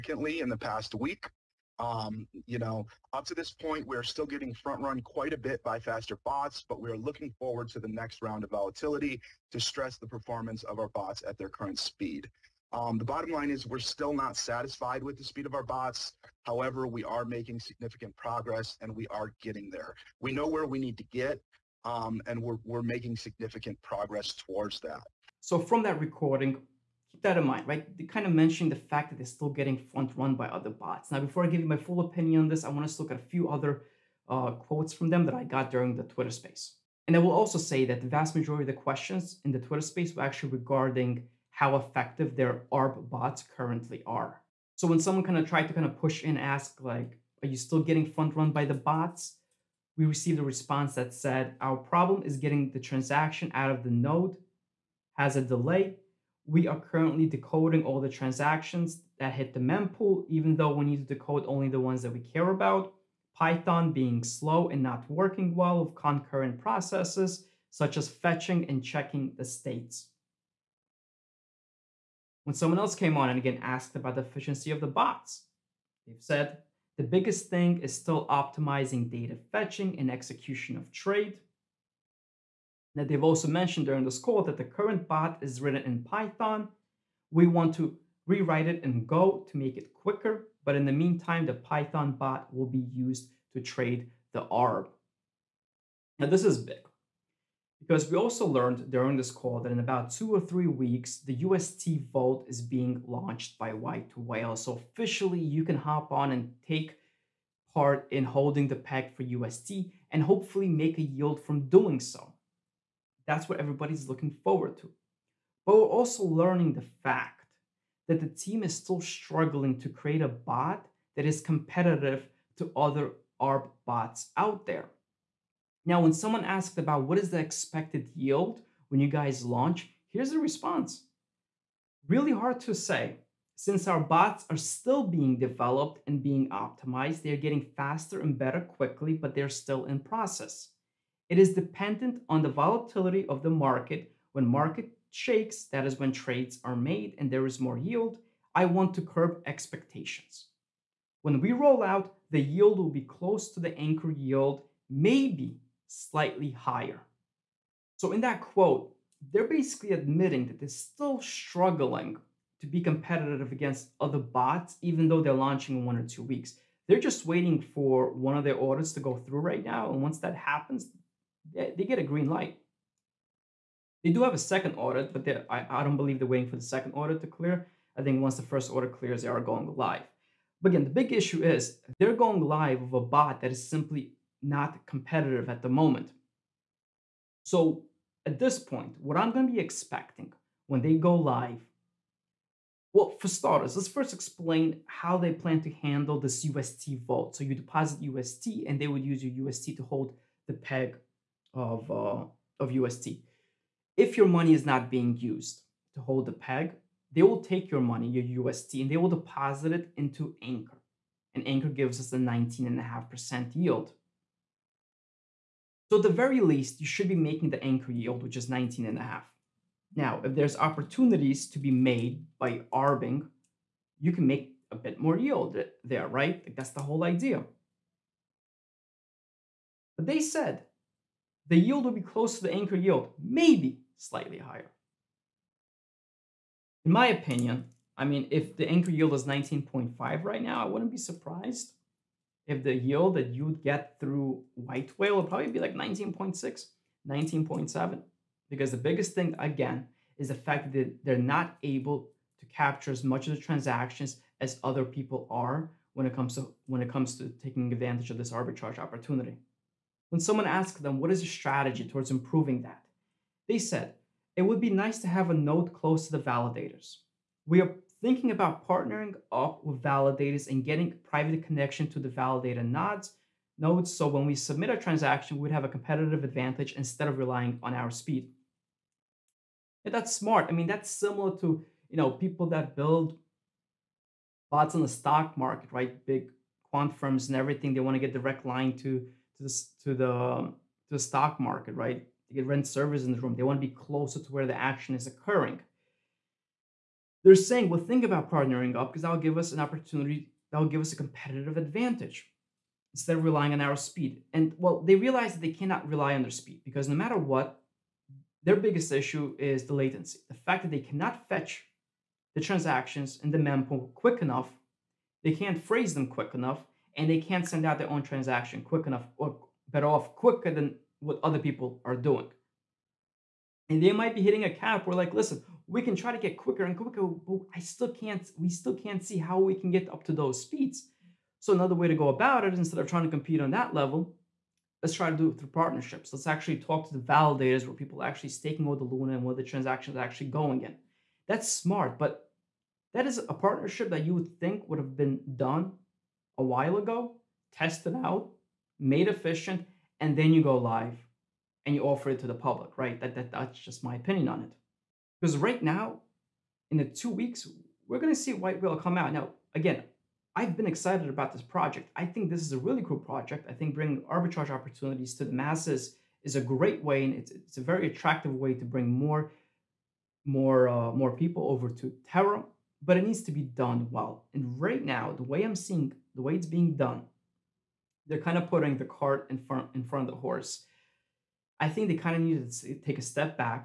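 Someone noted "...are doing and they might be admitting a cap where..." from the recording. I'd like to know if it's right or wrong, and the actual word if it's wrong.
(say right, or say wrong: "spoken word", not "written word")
wrong: "hitting", not "admitting".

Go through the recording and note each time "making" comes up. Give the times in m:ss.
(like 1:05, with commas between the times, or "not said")
0:17, 0:22, 3:37.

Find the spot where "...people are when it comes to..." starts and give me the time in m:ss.
4:14.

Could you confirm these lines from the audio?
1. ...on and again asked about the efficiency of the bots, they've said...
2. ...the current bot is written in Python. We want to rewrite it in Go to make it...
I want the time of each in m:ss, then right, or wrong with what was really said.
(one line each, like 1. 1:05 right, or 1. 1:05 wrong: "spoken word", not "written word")
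1. 1:13 right
2. 1:24 right.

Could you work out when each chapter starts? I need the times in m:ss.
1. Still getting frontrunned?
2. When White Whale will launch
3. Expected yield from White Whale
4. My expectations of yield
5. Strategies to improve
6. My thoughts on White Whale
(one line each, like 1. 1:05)
1. 0:46
2. 1:36
3. 2:04
4. 3:06
5. 4:18
6. 5:41.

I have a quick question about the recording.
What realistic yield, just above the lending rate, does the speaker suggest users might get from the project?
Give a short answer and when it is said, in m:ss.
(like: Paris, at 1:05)
19.6 or 19.7, at 4:05.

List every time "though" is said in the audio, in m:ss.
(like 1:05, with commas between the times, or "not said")
1:00, 2:45.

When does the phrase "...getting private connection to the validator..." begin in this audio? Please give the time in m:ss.
4:30.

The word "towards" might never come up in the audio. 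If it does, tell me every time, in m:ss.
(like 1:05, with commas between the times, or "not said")
0:24, 4:21.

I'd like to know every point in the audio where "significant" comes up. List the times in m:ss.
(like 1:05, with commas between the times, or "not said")
0:17, 0:23.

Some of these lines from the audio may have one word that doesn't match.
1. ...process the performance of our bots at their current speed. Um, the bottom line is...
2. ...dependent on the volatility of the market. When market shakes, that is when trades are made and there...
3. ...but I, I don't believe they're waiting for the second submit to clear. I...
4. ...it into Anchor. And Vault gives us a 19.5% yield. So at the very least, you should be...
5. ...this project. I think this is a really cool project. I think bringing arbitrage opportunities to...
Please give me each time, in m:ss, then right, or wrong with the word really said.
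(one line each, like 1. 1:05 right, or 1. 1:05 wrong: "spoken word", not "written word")
1. 0:09 wrong: "stress", not "process"
2. 2:21 right
3. 2:55 wrong: "audit", not "submit"
4. 3:29 wrong: "Anchor", not "Vault"
5. 6:01 right.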